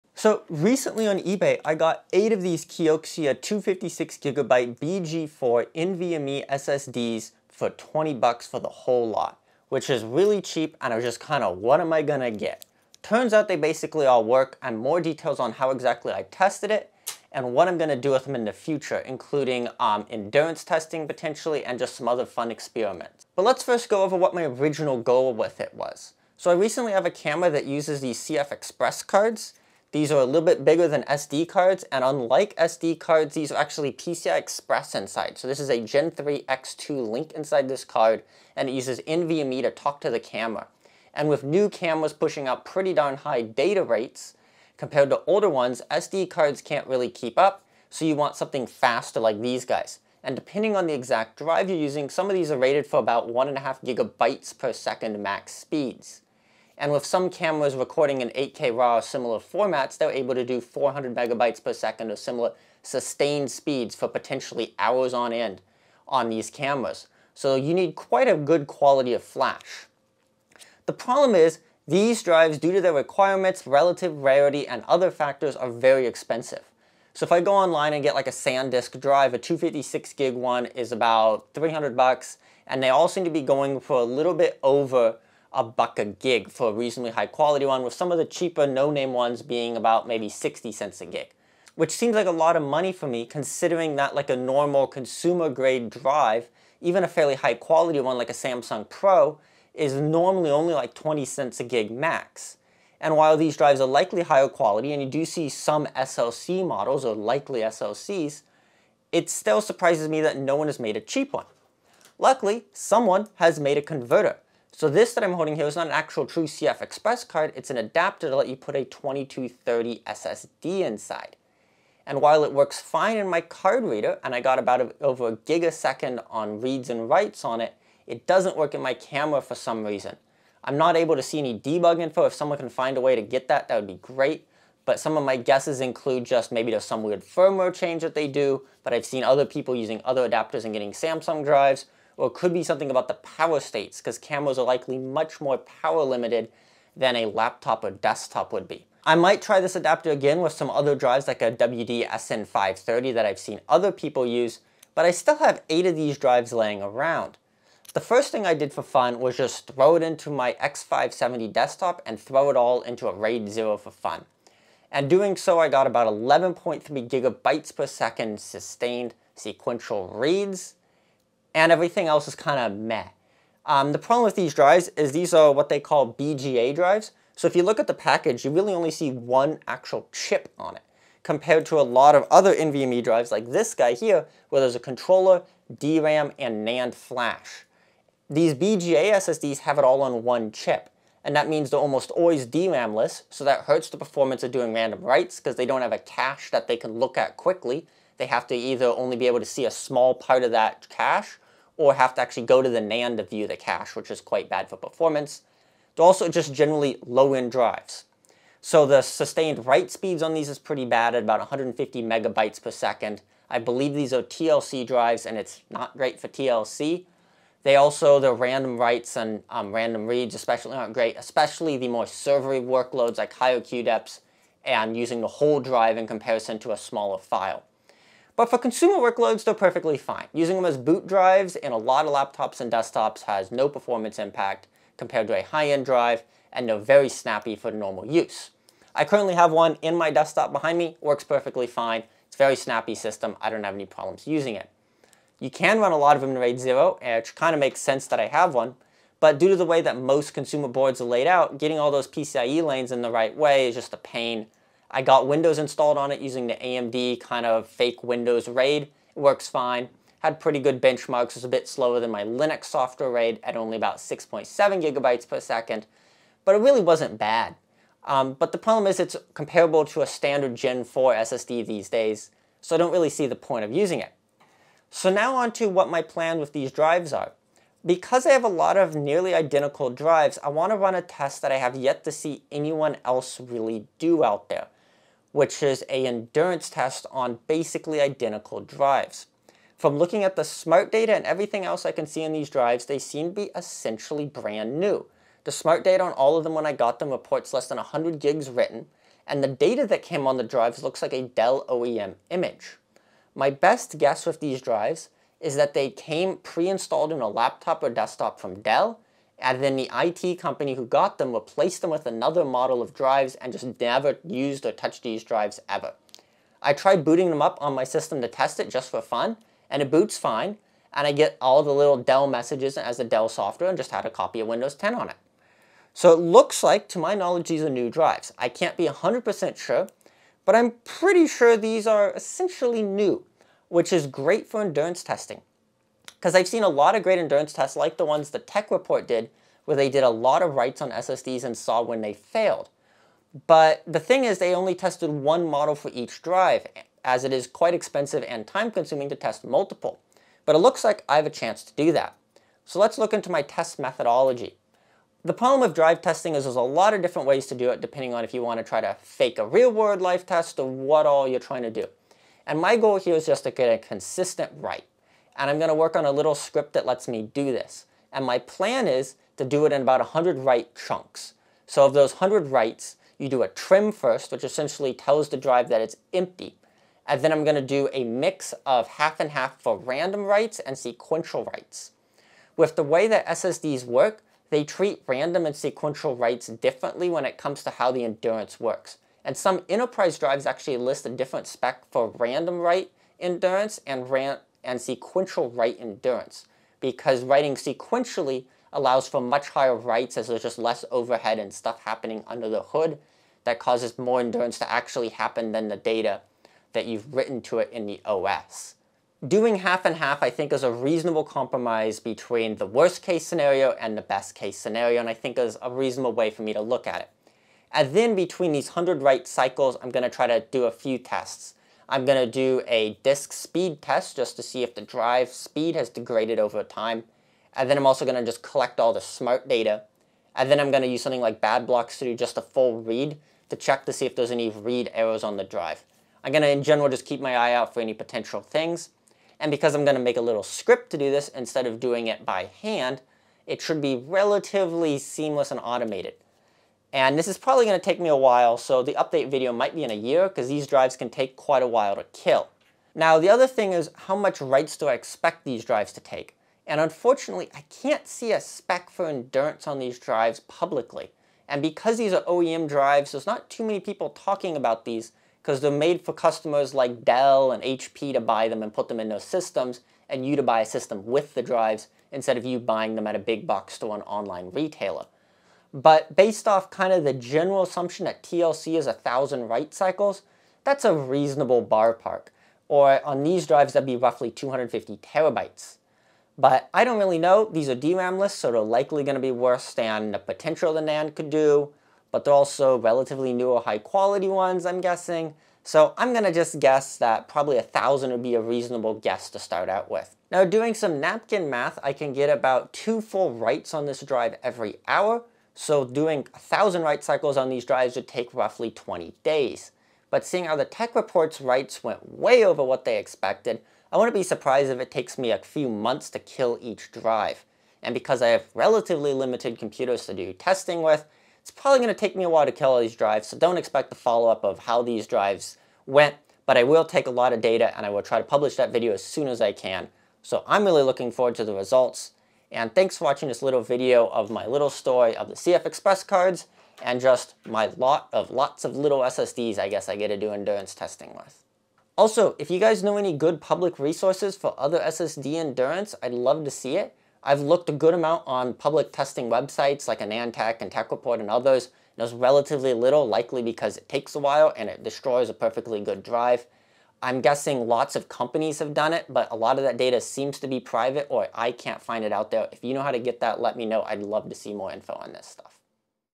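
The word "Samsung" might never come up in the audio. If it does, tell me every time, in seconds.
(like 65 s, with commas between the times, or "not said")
98 s, 140 s.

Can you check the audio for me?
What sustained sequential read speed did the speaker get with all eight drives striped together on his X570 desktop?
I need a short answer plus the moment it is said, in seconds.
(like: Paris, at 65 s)
11.3 GB/s, at 166 s.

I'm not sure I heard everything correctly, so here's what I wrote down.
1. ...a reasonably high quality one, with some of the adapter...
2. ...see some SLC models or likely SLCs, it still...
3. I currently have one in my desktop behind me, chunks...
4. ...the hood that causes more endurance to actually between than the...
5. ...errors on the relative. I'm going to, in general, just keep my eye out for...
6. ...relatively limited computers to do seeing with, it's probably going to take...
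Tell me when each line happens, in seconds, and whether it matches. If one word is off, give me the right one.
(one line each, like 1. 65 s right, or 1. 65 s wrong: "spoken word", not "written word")
1. 86 s wrong: "cheaper", not "adapter"
2. 105 s right
3. 238 s wrong: "works", not "chunks"
4. 402 s wrong: "happen", not "between"
5. 434 s wrong: "drive", not "relative"
6. 518 s wrong: "testing", not "seeing".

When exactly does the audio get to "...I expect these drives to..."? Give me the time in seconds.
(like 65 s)
454 s.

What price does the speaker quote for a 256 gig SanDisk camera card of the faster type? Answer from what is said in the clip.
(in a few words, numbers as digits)
$300.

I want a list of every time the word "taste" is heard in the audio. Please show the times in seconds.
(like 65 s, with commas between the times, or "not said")
not said.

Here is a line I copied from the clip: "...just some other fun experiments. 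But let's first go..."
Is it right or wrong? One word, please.
right.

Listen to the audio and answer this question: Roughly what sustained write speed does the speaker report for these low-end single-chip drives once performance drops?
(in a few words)
150 MB/s.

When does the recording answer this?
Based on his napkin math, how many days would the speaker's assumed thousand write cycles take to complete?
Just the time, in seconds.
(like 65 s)
508 s.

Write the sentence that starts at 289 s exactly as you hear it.
From looking at the smart data and everything else I can see in these drives, they seem to be essentially brand new.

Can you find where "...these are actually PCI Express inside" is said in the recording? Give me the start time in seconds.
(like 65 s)
33 s.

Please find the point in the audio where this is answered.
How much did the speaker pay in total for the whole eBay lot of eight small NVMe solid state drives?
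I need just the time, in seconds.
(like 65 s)
7 s.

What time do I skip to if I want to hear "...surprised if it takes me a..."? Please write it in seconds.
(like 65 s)
514 s.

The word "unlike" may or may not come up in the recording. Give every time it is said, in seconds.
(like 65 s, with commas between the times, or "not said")
32 s.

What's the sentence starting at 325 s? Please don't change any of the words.
So it looks like, to my knowledge, these are new drives.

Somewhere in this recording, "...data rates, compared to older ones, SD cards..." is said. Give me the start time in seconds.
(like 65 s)
43 s.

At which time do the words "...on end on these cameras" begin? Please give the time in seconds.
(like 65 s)
65 s.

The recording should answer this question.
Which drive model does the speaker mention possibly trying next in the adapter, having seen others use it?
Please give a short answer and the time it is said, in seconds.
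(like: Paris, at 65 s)
WD SN530, at 151 s.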